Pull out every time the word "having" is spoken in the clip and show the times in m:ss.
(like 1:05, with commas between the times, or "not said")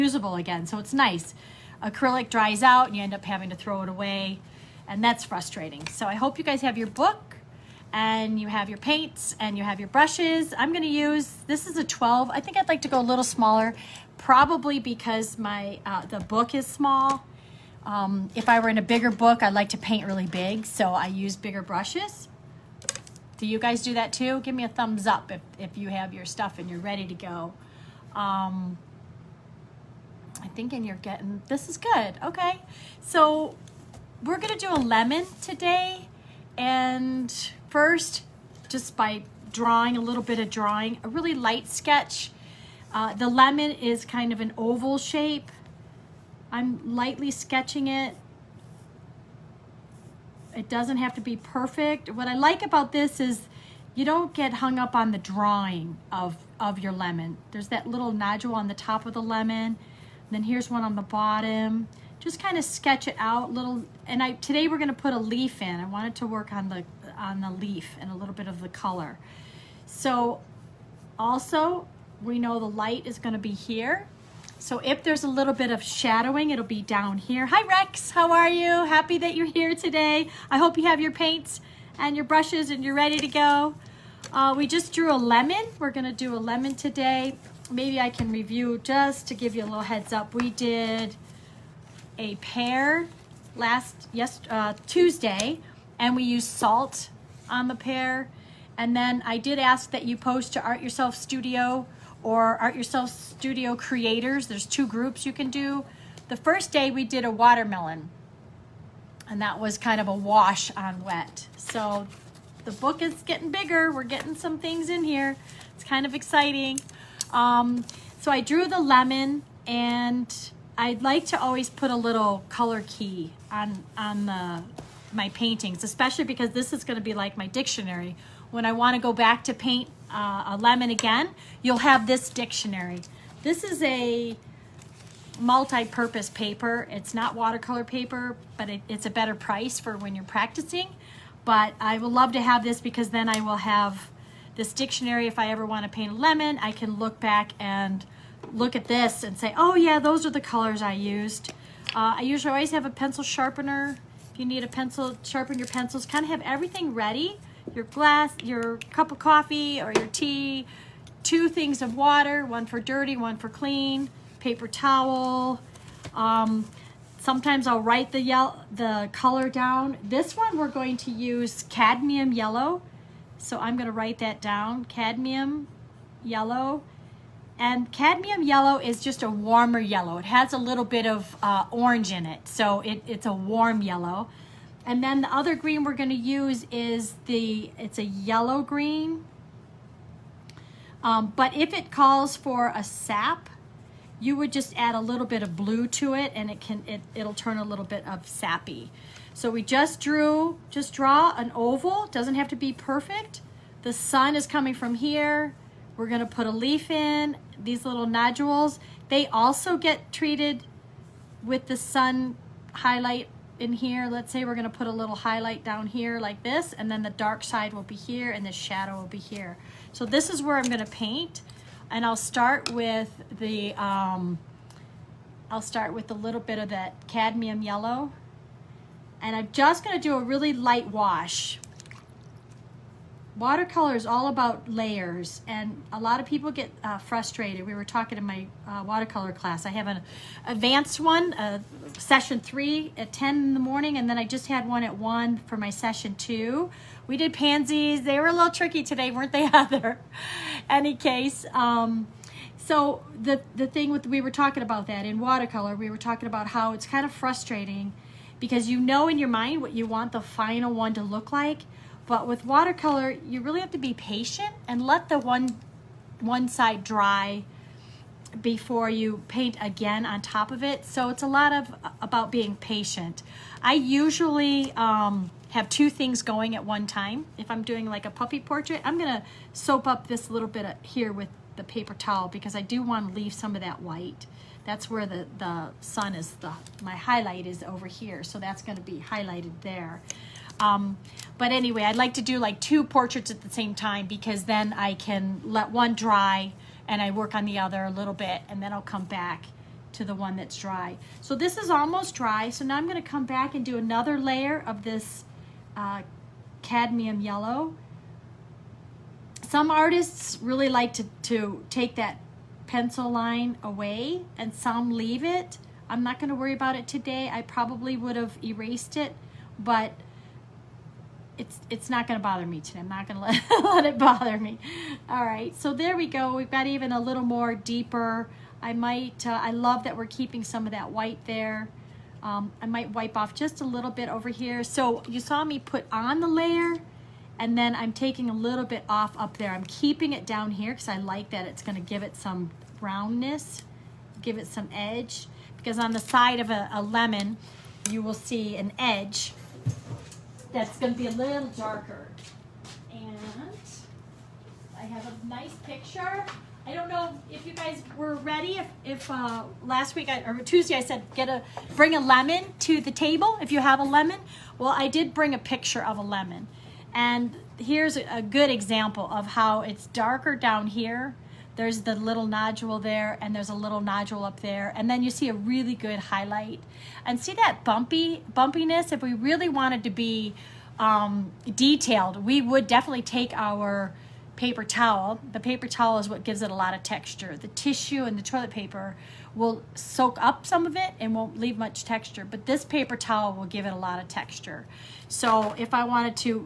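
0:03.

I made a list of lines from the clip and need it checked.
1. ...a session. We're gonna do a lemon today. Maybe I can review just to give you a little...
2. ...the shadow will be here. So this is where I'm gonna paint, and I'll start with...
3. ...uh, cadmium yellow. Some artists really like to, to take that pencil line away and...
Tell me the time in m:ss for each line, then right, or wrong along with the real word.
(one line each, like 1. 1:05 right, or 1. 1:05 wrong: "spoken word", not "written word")
1. 1:25 wrong: "lemon", not "session"
2. 3:38 right
3. 5:05 right.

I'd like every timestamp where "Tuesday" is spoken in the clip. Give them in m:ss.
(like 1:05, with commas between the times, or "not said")
1:34, 6:00.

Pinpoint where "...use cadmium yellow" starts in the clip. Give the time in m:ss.
2:51.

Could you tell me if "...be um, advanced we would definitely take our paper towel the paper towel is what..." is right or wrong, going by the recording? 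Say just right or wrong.
wrong.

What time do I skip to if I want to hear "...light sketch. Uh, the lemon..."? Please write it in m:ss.
0:41.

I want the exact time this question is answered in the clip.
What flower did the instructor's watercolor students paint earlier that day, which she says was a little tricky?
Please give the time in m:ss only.
4:07.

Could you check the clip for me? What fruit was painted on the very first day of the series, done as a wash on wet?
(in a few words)
Watermelon.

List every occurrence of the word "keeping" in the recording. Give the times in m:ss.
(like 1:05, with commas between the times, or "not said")
5:30, 5:39.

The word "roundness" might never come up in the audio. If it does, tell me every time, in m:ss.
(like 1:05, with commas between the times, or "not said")
5:42.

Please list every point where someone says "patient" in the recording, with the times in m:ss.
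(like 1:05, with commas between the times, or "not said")
4:23, 4:32.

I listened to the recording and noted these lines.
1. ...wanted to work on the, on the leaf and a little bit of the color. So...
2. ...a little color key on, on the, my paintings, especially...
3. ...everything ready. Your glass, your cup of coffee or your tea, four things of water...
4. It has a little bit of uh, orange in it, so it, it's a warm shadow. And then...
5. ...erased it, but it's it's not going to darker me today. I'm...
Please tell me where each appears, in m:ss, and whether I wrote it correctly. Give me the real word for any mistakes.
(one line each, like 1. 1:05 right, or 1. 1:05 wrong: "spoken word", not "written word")
1. 1:05 right
2. 2:01 right
3. 2:36 wrong: "two", not "four"
4. 3:00 wrong: "yellow", not "shadow"
5. 5:18 wrong: "bother", not "darker".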